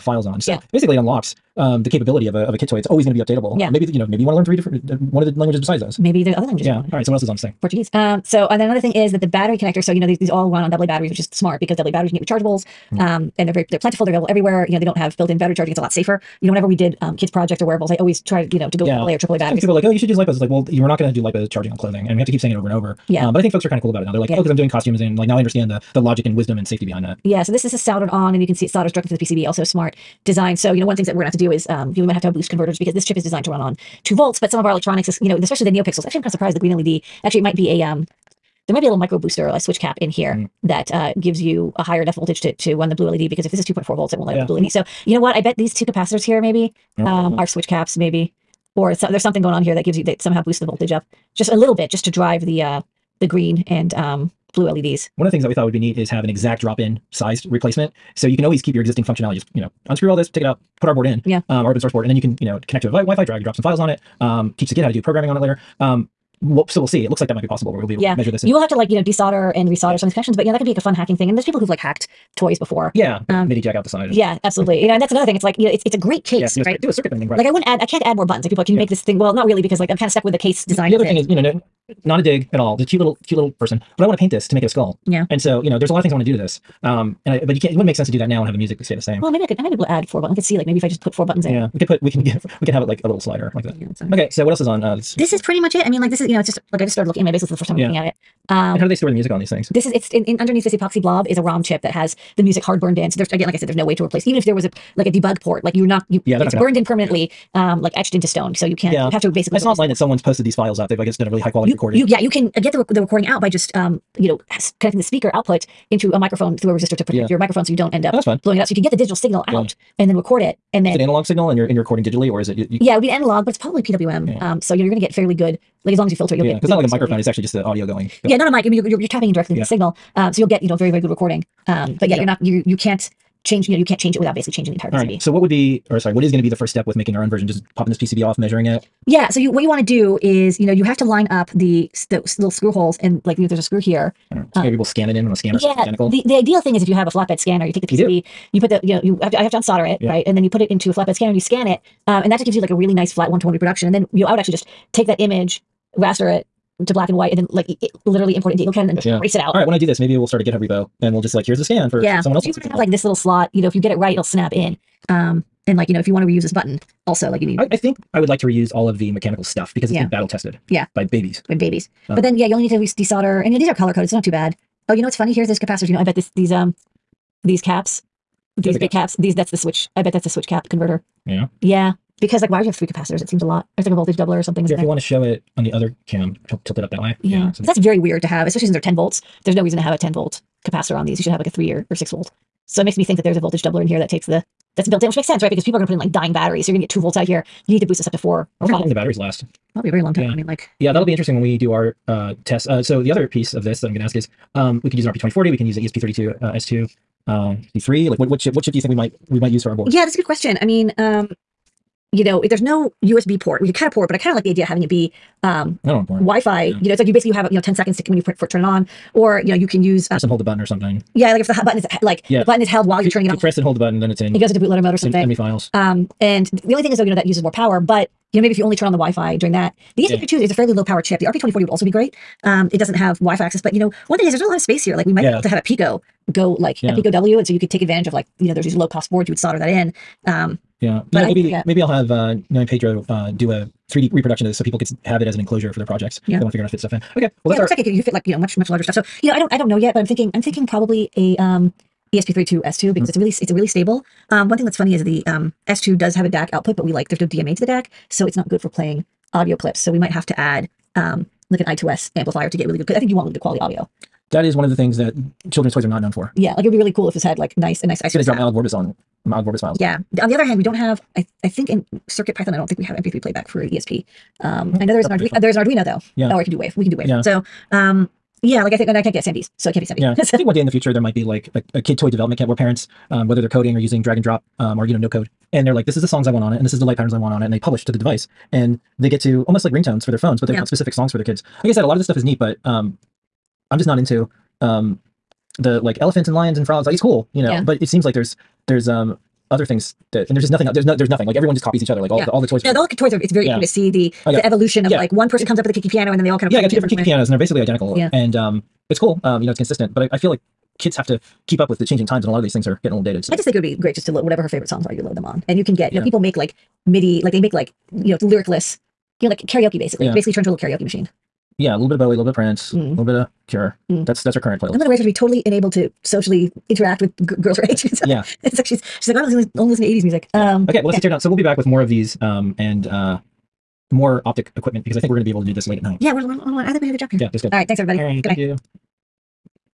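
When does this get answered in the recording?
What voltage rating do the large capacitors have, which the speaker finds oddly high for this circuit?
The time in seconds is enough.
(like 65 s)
188 s.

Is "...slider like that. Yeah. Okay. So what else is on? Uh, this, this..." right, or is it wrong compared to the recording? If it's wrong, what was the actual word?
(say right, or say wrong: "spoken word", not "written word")
right.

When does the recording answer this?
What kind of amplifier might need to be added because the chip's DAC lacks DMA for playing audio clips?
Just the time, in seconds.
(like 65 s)
261 s.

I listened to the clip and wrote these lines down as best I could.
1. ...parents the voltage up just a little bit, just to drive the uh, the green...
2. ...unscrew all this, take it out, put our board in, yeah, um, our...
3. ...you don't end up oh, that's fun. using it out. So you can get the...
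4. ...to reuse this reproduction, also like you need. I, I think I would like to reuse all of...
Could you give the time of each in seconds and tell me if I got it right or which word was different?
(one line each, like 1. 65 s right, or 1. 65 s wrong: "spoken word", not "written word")
1. 50 s wrong: "boosts", not "parents"
2. 59 s right
3. 117 s wrong: "blowing", not "using"
4. 166 s wrong: "button", not "reproduction".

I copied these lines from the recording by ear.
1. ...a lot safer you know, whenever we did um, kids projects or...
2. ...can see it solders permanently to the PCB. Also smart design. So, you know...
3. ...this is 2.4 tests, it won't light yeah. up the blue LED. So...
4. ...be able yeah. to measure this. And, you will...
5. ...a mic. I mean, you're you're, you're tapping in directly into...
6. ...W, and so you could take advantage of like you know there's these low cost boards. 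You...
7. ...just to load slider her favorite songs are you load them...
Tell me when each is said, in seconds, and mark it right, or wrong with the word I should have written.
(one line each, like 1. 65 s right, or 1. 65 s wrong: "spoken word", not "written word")
1. 15 s right
2. 28 s wrong: "directly", not "permanently"
3. 43 s wrong: "volts", not "tests"
4. 67 s right
5. 128 s right
6. 237 s right
7. 313 s wrong: "whatever", not "slider".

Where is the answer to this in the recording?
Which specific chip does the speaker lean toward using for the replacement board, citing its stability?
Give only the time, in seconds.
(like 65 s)
252 s.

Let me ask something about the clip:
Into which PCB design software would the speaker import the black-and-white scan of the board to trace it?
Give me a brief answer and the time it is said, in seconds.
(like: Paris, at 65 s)
EagleCAD, at 158 s.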